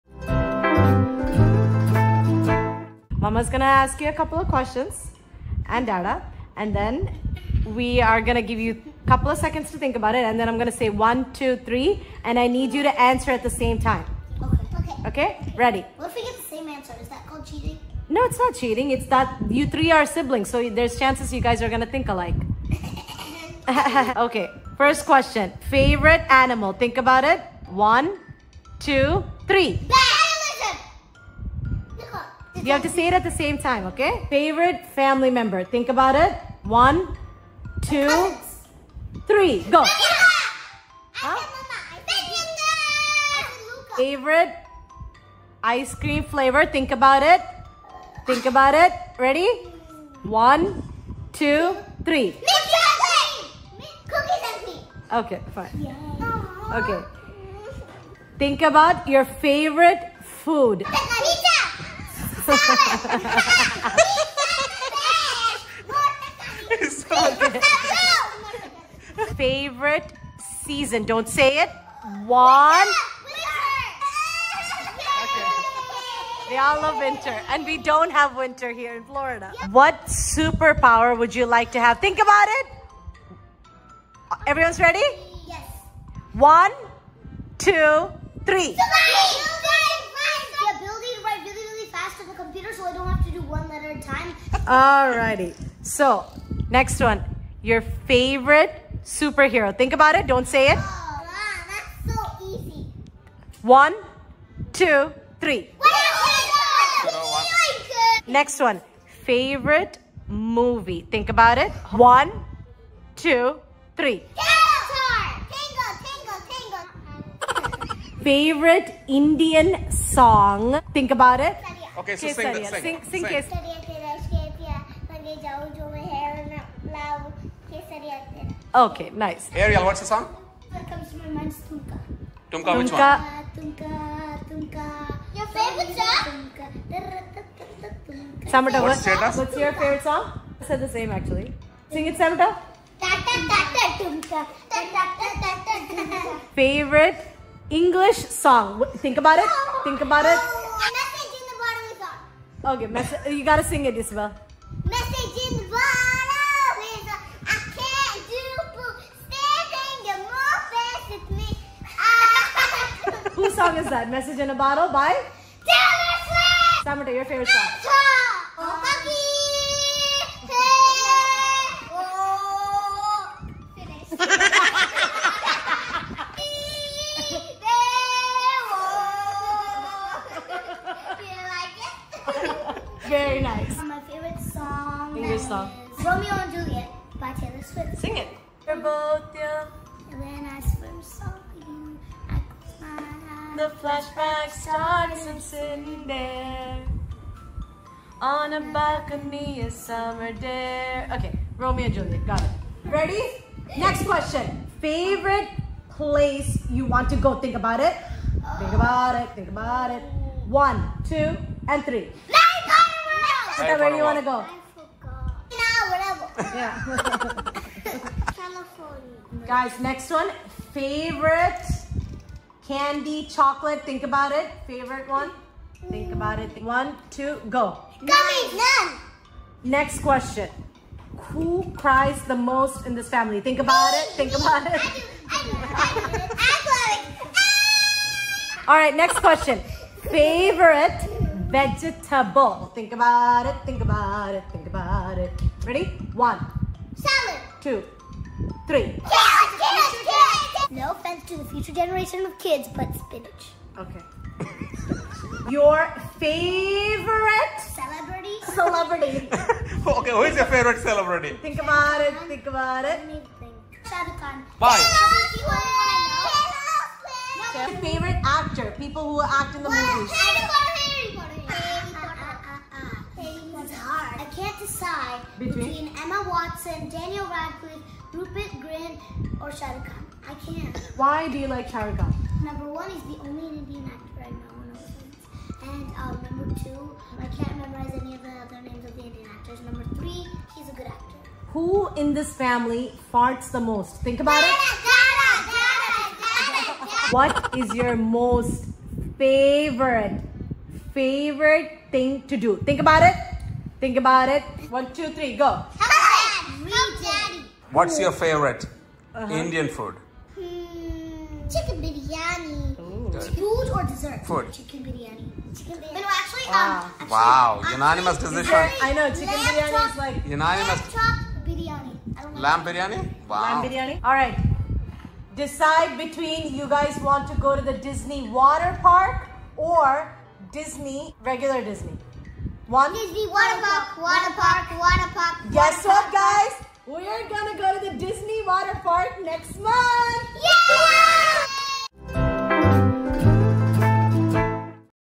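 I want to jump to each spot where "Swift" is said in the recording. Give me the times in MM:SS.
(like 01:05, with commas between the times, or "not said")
02:46, 03:07.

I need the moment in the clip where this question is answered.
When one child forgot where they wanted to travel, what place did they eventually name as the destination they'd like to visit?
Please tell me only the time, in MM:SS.
03:38.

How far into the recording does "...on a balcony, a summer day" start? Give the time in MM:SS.
03:18.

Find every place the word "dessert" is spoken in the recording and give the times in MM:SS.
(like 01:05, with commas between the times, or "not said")
05:13.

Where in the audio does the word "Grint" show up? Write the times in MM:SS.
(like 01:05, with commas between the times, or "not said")
04:38.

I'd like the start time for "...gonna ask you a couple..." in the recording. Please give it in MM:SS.
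00:03.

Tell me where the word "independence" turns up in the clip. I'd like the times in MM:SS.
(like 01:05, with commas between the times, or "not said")
not said.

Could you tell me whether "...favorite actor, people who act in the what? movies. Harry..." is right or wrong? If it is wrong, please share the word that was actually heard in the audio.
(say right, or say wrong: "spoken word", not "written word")
right.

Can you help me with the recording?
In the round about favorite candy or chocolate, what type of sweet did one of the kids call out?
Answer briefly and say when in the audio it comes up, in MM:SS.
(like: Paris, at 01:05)
Gummies, at 03:48.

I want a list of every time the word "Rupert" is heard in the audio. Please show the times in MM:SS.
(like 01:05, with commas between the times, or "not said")
04:38.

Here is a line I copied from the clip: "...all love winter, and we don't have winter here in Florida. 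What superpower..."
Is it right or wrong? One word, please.
right.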